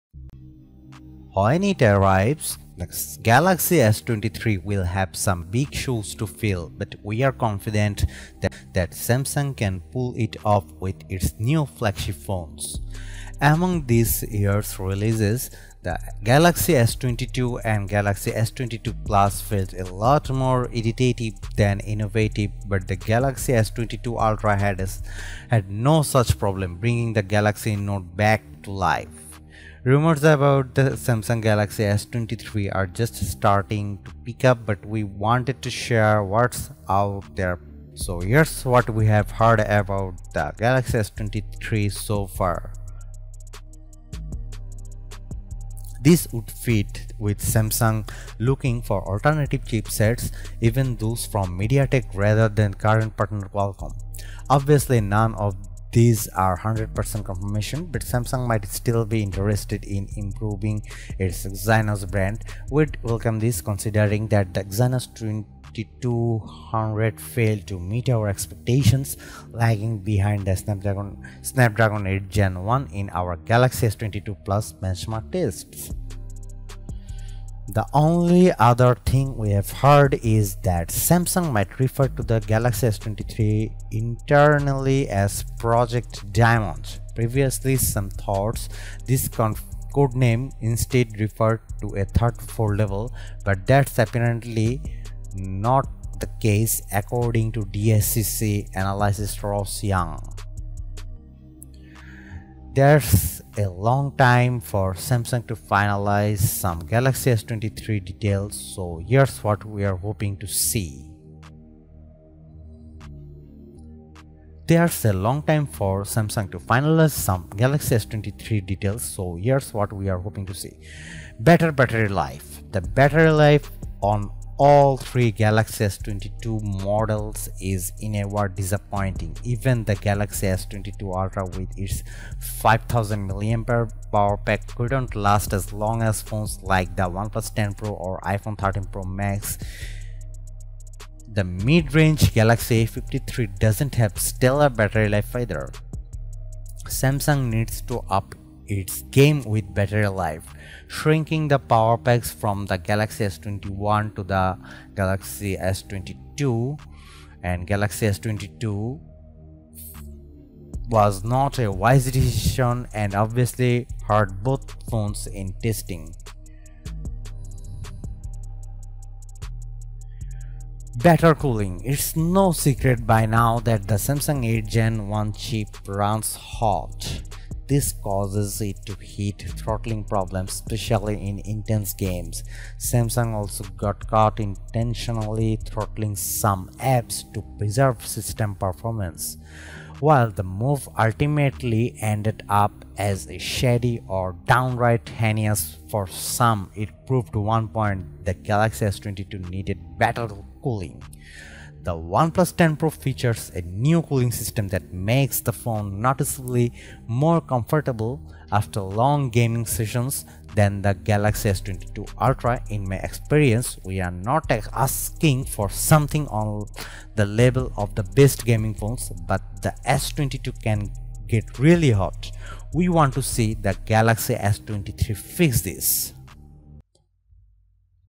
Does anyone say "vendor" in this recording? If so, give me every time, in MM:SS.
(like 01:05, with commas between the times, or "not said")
not said.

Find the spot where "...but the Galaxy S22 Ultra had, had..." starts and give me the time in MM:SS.
00:22.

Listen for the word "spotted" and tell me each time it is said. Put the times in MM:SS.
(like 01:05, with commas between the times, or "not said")
not said.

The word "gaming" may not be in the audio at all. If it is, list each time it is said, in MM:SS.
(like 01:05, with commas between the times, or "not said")
03:29, 03:38.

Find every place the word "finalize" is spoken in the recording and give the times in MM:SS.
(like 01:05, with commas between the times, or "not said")
01:45, 01:56.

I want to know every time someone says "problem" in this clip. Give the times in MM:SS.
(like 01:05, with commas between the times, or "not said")
00:26, 03:00.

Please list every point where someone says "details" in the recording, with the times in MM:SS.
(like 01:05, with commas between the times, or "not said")
01:48, 01:58.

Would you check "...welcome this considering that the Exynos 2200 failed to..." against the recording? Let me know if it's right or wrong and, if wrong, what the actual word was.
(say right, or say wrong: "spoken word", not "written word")
right.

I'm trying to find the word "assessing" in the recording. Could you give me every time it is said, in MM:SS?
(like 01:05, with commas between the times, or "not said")
not said.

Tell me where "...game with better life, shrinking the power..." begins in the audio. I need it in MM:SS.
02:29.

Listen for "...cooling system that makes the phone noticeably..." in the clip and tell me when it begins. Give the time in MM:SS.
03:24.